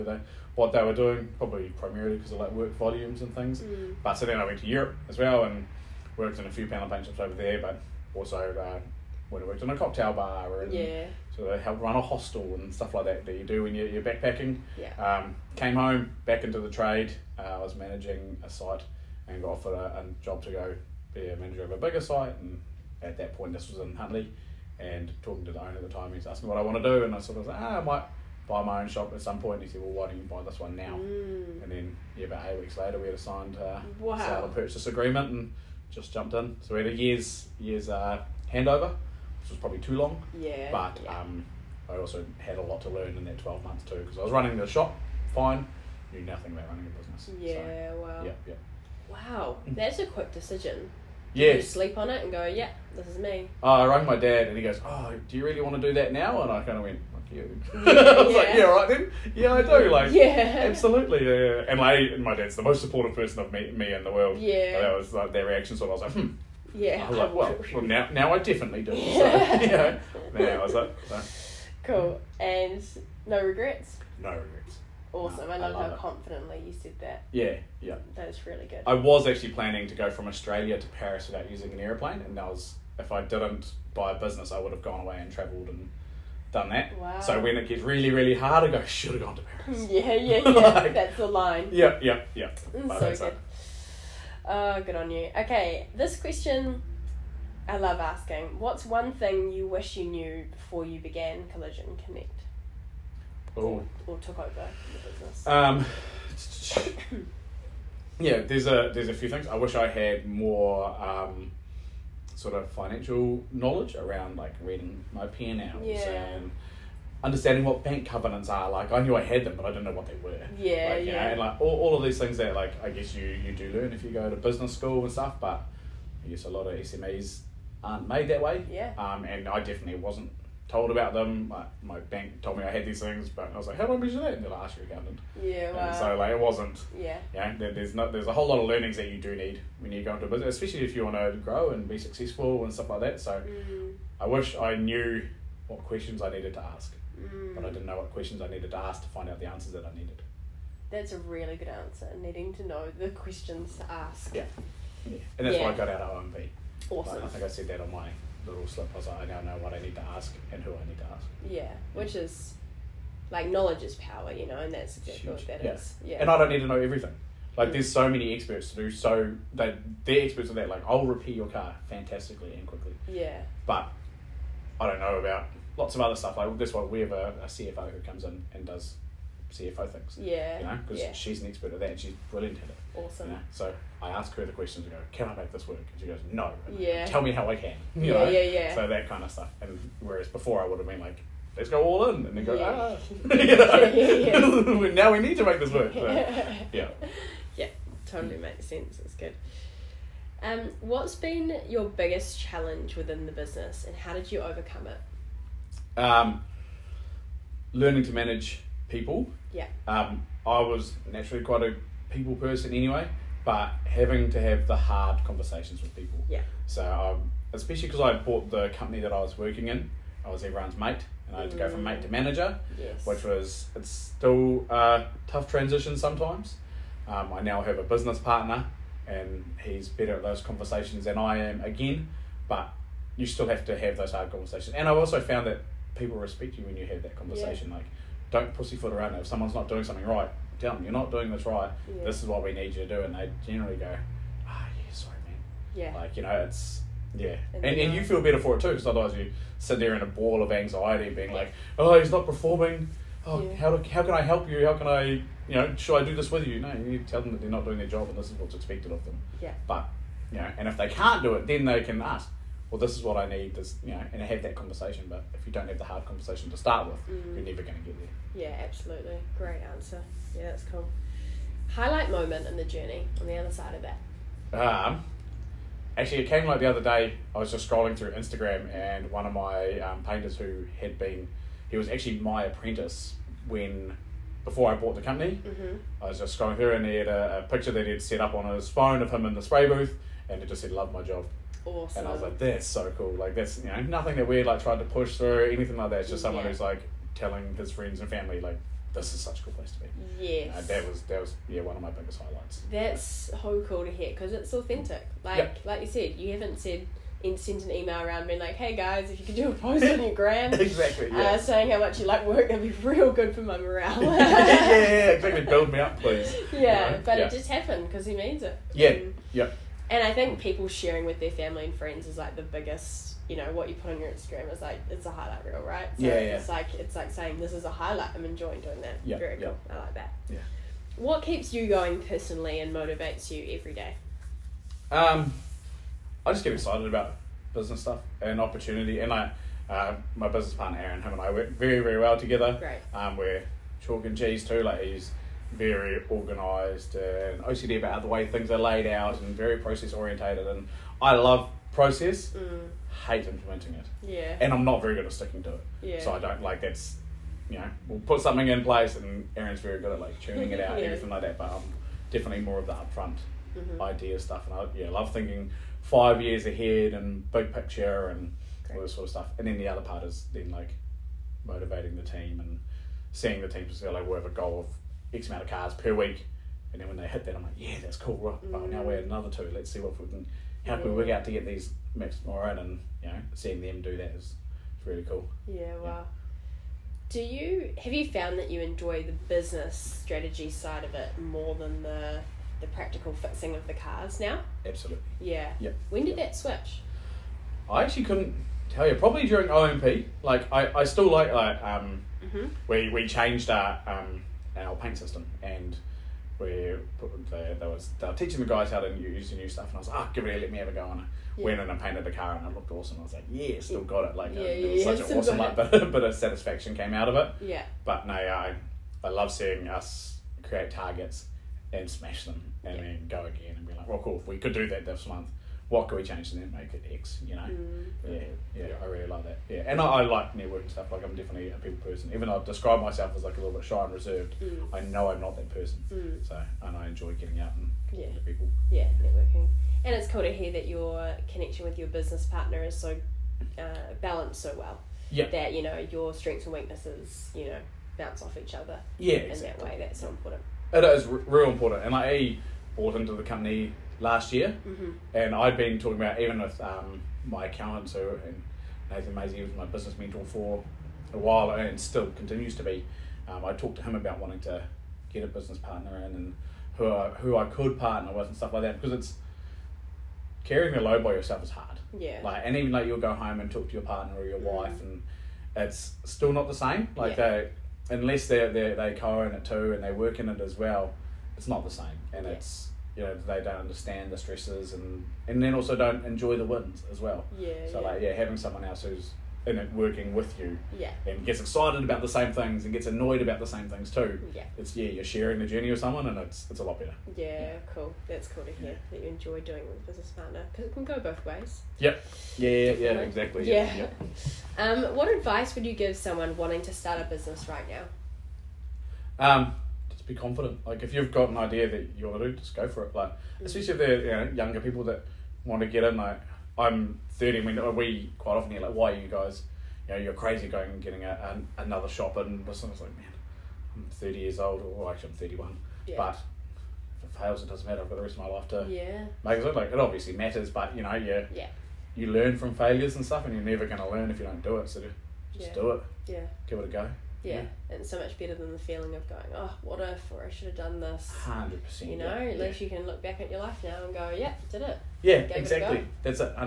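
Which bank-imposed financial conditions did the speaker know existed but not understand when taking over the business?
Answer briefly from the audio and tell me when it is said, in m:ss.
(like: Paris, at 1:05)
Bank covenants, at 1:57.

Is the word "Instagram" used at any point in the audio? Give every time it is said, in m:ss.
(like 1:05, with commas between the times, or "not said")
4:38, 5:24.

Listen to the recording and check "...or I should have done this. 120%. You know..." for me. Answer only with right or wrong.
wrong.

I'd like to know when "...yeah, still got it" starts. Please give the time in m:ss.
6:53.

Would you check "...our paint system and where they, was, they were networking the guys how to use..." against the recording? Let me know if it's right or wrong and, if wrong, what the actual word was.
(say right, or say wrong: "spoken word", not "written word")
wrong: "teaching", not "networking".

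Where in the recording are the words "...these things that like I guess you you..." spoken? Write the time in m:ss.
2:02.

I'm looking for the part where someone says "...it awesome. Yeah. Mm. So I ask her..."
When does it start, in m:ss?
3:02.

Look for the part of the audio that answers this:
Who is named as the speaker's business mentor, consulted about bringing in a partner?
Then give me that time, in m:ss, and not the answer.
7:38.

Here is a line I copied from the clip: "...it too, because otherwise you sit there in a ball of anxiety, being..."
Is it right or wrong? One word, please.
right.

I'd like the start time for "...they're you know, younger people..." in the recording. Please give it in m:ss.
8:33.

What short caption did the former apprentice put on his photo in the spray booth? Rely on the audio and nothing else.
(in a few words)
Love my job.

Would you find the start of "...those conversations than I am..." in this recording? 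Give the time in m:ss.
3:50.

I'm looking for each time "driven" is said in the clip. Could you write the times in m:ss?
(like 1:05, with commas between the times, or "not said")
not said.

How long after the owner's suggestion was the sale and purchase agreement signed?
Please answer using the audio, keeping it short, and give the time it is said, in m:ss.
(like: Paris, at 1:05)
About 8 weeks, at 0:32.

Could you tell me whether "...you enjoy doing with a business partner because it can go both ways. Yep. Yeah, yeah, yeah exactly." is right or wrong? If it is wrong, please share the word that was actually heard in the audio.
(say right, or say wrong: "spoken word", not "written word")
right.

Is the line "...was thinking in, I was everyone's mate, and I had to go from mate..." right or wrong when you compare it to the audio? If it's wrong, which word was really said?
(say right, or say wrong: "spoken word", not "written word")
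wrong: "working", not "thinking".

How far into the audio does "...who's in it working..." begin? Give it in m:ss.
8:08.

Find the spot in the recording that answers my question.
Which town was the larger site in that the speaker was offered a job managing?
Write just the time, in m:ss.
0:23.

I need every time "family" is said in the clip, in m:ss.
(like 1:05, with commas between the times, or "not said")
4:58, 5:21.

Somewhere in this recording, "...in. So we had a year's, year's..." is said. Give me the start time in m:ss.
0:36.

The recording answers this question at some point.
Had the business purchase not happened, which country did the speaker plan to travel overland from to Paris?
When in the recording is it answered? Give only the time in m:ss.
1:20.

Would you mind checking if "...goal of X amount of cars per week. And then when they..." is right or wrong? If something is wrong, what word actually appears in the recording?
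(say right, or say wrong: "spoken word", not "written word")
right.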